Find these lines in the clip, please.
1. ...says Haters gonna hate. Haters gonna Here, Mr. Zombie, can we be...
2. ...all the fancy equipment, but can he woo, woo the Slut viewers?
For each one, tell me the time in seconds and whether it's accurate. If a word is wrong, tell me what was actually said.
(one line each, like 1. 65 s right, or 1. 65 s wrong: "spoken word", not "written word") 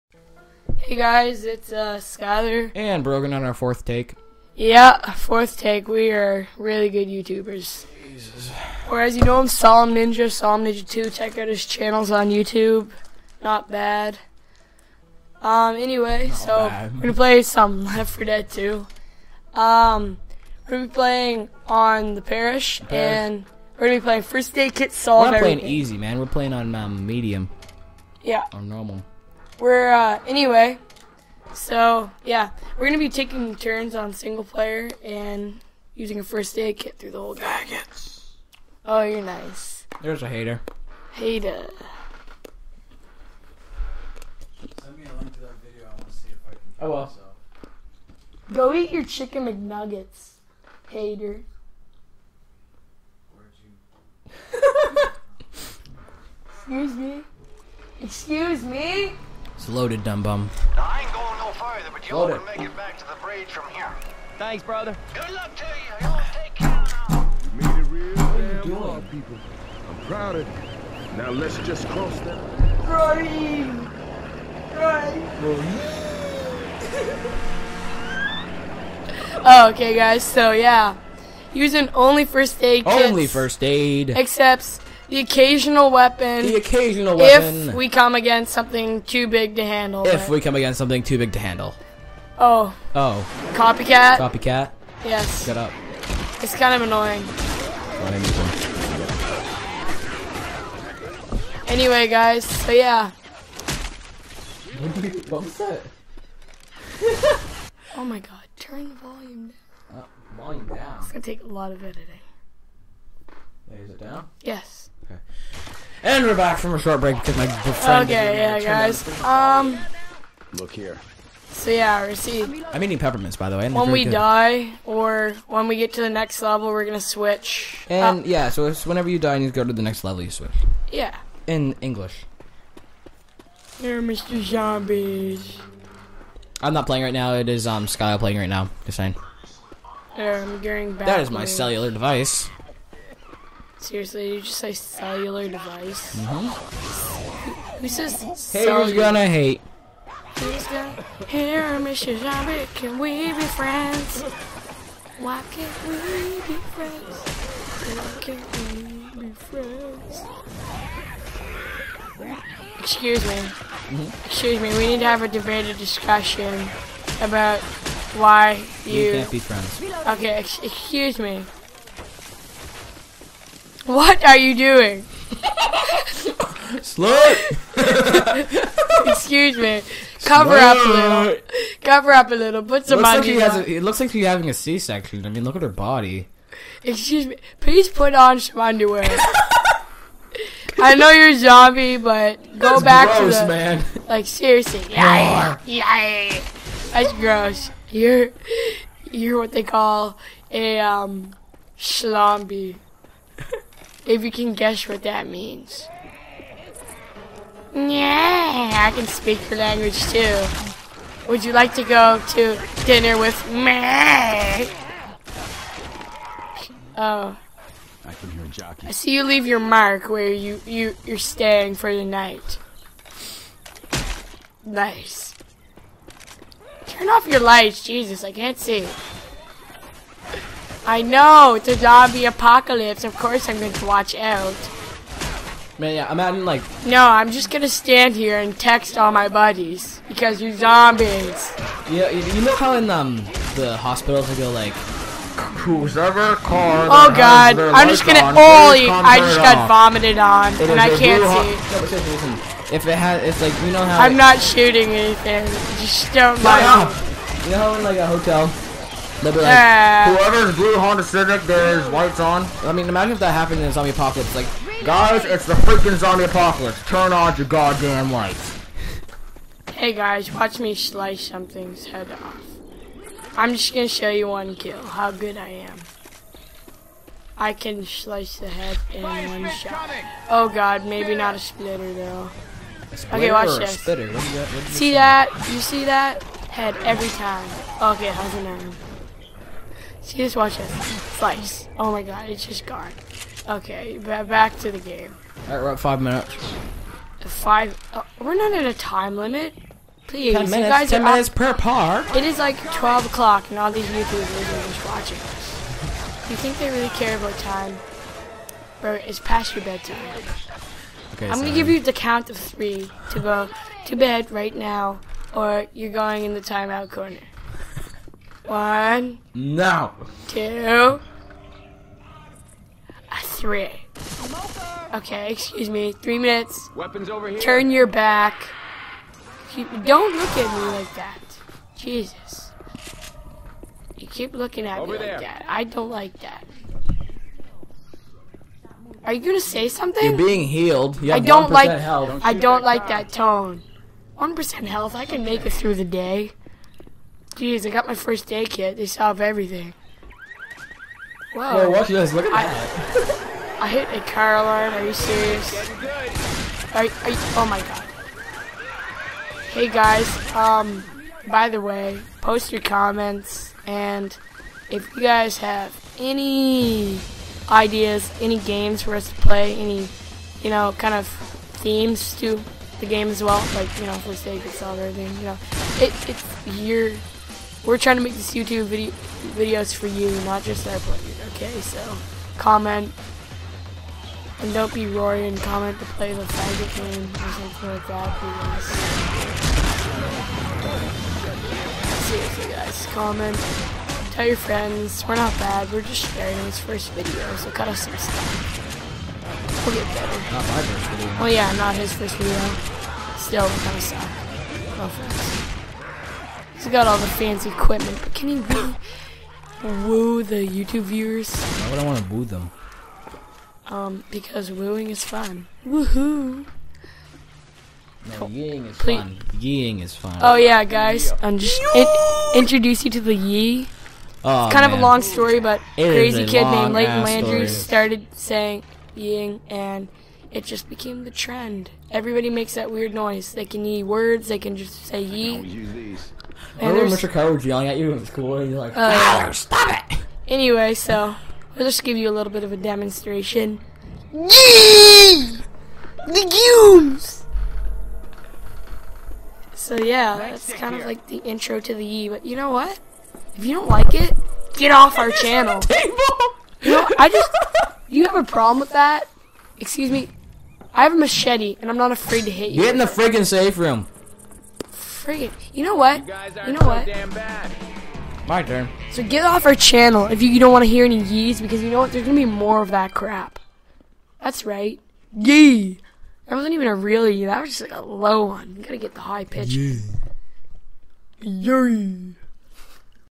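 1. 147 s right
2. 406 s wrong: "YouTube", not "Slut".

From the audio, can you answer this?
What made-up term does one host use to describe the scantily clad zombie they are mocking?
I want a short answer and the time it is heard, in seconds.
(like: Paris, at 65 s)
Schlombie, at 201 s.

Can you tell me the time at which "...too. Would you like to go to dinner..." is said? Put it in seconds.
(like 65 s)
210 s.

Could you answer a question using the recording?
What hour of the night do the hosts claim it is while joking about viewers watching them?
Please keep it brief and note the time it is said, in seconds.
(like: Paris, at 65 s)
12 o'clock, at 302 s.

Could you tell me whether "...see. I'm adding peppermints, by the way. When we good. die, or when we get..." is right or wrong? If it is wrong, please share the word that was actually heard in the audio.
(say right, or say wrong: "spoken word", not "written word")
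wrong: "eating", not "adding".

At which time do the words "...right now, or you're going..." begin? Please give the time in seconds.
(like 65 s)
314 s.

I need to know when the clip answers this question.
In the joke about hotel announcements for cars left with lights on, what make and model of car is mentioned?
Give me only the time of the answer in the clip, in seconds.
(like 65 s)
260 s.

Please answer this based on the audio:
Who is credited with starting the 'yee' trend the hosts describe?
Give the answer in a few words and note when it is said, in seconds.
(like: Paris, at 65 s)
Leighton Landry, at 426 s.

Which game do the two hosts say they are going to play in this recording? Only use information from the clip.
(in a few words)
Left 4 Dead 2.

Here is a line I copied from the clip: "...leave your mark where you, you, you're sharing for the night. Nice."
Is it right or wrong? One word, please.
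wrong.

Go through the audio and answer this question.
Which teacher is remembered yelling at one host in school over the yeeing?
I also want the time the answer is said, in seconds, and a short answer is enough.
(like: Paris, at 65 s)
Mr. Carr, at 436 s.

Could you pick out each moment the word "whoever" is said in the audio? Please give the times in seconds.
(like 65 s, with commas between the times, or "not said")
245 s, 260 s.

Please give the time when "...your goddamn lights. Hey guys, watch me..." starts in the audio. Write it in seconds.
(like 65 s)
267 s.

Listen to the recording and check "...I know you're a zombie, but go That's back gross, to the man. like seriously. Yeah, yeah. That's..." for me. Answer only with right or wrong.
right.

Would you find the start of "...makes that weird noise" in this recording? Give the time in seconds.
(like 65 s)
432 s.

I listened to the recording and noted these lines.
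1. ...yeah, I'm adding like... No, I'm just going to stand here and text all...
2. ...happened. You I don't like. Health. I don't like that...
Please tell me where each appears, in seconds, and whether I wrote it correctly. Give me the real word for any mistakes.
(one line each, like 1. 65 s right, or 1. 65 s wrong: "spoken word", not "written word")
1. 235 s right
2. 340 s wrong: "healed", not "happened".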